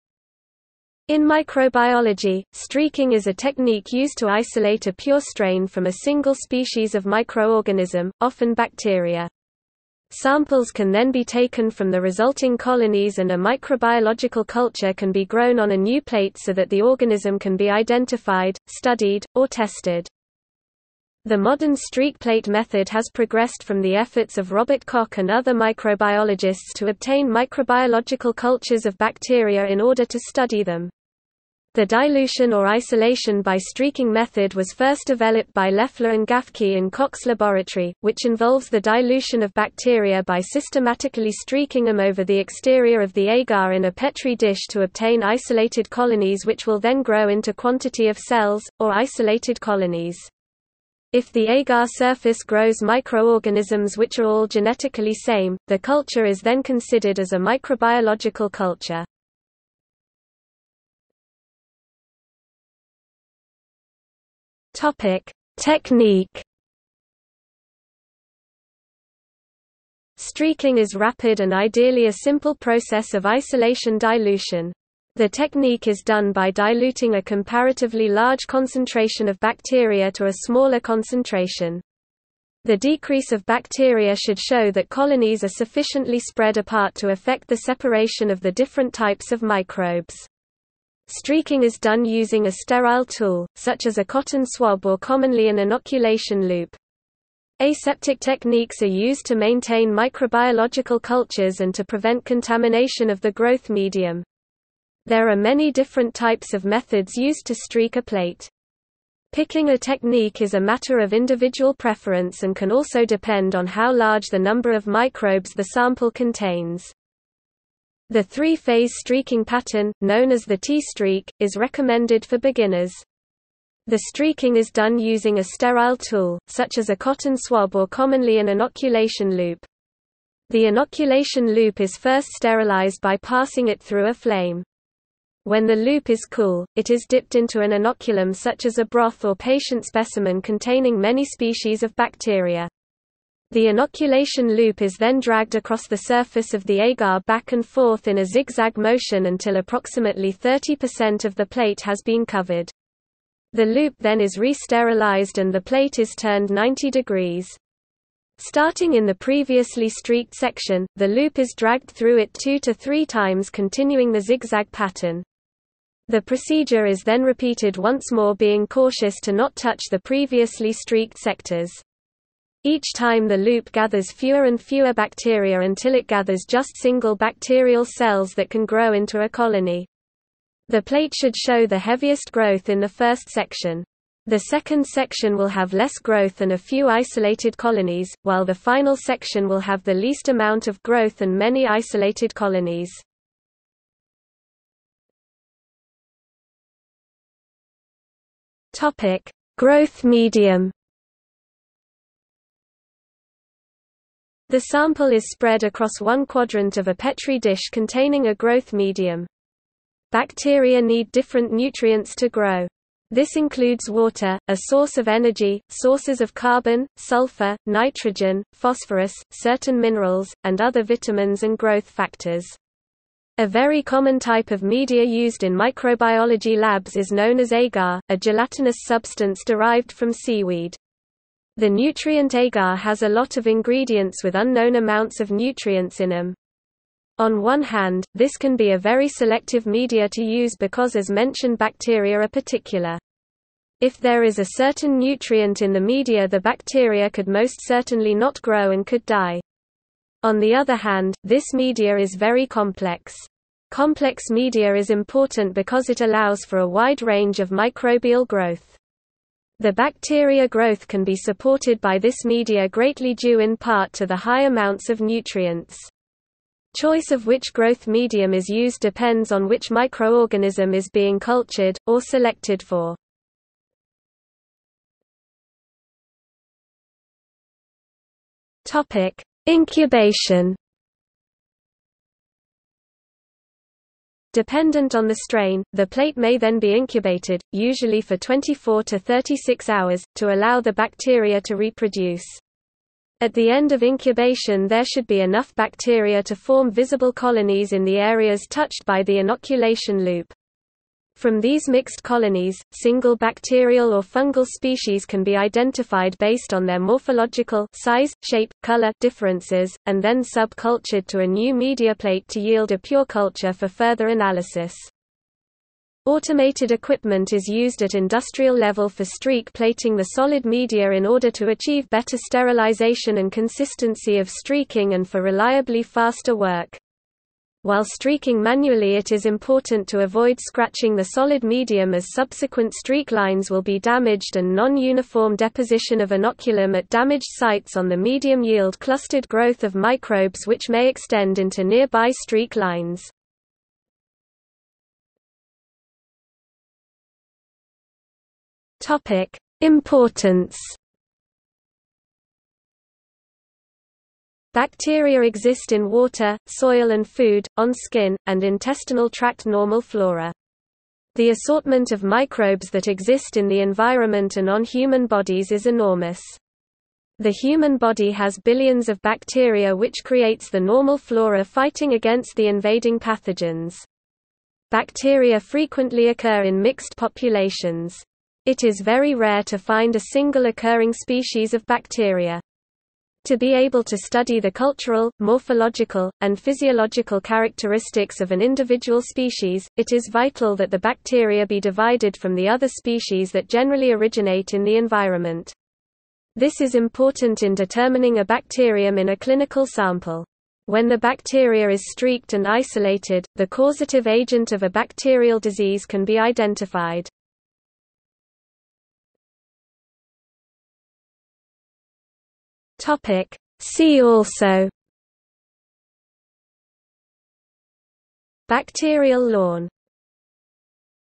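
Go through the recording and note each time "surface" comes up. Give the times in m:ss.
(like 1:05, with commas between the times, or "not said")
0:51, 2:25.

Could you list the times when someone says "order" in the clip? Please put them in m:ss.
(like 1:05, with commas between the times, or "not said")
0:29, 5:21.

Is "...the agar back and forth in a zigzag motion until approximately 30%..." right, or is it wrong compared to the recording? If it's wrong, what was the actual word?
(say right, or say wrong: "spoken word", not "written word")
right.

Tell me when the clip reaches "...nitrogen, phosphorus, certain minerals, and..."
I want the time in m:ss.
3:37.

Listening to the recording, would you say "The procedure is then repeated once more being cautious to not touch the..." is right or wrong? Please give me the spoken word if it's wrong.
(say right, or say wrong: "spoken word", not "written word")
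right.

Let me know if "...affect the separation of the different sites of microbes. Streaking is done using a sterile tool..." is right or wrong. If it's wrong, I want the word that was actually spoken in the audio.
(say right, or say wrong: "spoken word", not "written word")
wrong: "types", not "sites".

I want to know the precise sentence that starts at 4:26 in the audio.
Choice of which growth medium is used depends on which microorganism is being cultured, or selected for.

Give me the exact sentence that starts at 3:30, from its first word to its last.
Bacteria need different nutrients to grow.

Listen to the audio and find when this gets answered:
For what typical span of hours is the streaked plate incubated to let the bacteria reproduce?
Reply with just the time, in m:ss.
4:48.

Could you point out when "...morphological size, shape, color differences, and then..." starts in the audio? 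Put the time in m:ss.
5:06.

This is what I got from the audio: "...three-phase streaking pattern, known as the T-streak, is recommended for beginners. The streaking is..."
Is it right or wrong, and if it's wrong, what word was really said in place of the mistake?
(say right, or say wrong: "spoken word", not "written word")
right.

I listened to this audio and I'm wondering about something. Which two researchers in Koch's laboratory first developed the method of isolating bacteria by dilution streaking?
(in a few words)
Loeffler and Gaffky.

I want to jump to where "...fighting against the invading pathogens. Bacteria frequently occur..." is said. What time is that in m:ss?
6:11.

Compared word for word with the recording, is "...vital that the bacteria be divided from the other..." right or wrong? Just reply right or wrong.
right.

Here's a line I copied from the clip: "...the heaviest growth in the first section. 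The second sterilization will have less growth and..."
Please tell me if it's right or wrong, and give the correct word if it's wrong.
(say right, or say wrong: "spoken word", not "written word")
wrong: "section", not "sterilization".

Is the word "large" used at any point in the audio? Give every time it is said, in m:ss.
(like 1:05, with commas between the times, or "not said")
1:18, 1:53.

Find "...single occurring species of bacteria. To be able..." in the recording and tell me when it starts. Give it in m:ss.
6:20.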